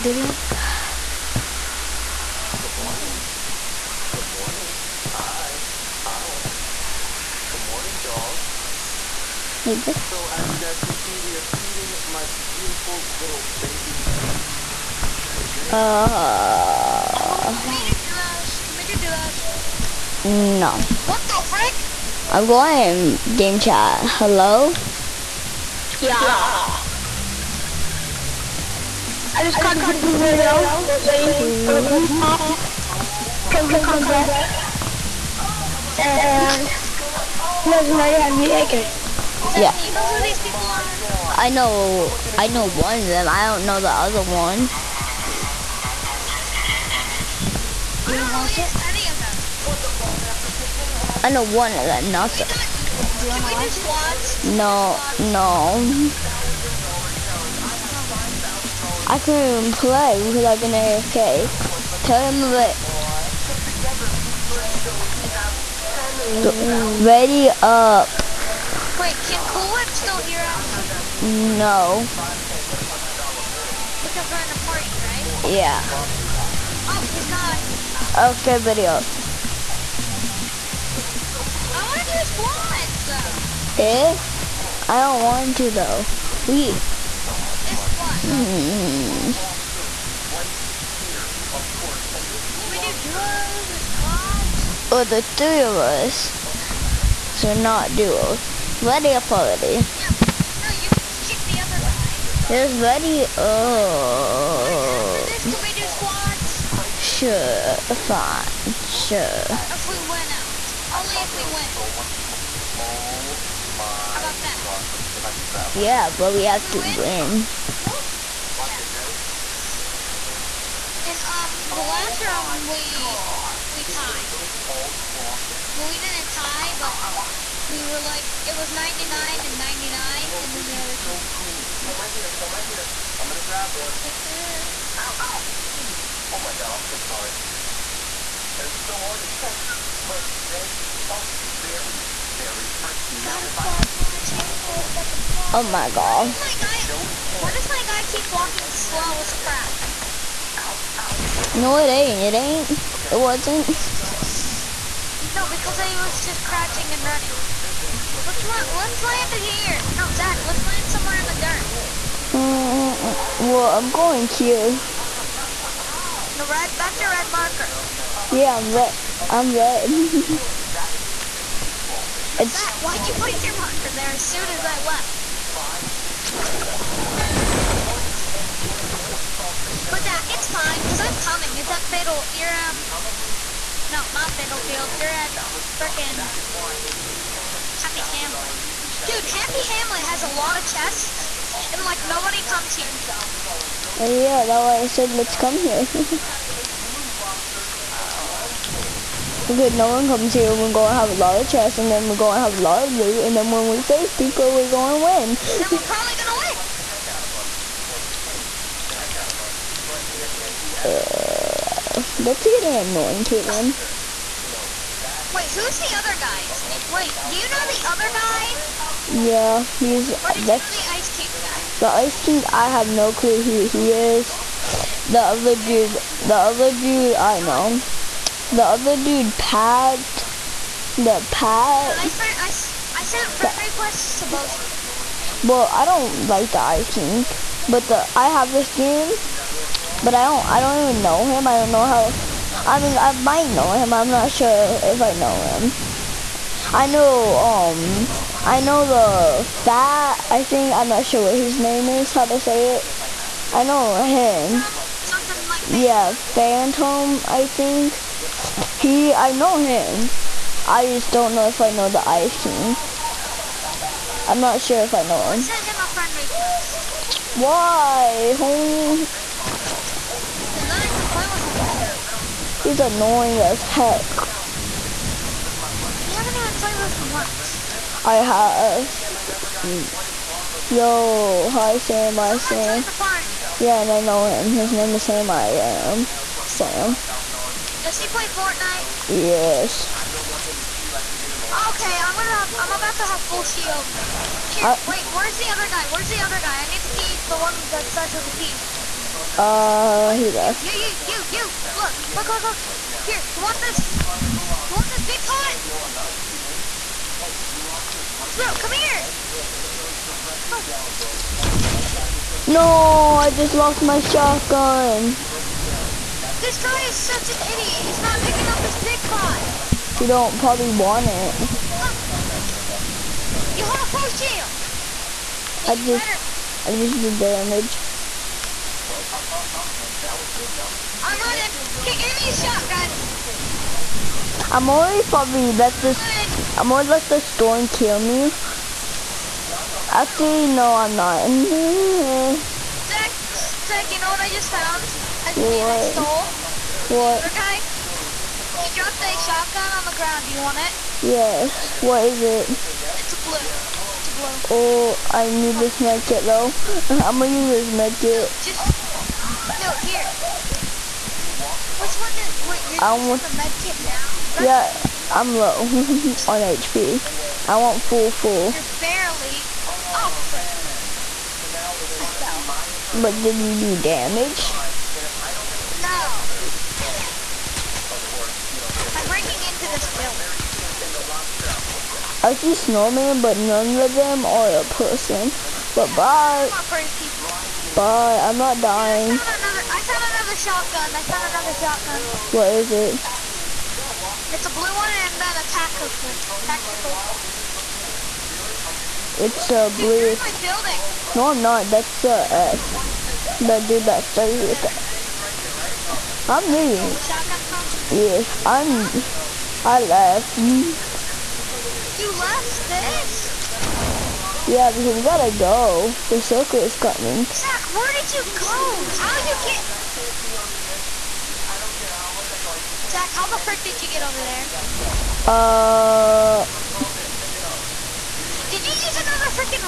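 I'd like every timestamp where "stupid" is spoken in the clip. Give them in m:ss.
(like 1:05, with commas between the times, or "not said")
6:04.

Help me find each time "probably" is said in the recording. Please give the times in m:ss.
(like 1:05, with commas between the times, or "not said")
3:25, 5:20, 5:35.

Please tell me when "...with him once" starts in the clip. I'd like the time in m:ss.
4:36.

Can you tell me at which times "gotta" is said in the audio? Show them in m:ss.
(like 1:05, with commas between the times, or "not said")
6:55.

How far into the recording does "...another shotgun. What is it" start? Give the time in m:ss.
6:31.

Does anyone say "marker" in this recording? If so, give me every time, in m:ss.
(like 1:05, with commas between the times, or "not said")
2:47, 2:53.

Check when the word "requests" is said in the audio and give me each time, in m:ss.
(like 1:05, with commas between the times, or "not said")
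3:53, 4:26.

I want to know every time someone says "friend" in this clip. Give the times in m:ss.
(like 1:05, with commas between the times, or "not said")
3:53, 4:25.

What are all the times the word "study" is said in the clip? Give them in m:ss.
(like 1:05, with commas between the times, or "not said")
not said.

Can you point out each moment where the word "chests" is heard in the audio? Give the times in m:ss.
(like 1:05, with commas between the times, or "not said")
3:10, 3:21.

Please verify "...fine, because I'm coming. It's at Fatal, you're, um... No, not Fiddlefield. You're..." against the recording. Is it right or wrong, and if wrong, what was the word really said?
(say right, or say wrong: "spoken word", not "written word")
right.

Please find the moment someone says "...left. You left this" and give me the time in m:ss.
6:49.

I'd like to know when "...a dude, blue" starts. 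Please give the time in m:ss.
6:39.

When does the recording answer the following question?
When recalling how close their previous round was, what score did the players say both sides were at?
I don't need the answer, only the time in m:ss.
2:08.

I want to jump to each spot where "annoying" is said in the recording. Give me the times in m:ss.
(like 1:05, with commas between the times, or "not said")
3:32, 4:32.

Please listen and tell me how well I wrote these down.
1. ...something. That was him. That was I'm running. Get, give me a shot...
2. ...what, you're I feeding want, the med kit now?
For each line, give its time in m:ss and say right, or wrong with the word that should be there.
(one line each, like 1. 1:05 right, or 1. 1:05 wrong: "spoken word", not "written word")
1. 5:29 right
2. 6:02 wrong: "using", not "feeding".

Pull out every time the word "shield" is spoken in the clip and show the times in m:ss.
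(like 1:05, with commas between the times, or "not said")
4:53, 5:24.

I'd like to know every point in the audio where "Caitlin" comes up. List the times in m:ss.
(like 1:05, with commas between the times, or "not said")
3:33.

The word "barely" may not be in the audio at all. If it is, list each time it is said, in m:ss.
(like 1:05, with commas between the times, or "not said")
6:08.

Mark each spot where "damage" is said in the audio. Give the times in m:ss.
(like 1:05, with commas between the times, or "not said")
5:27, 6:13.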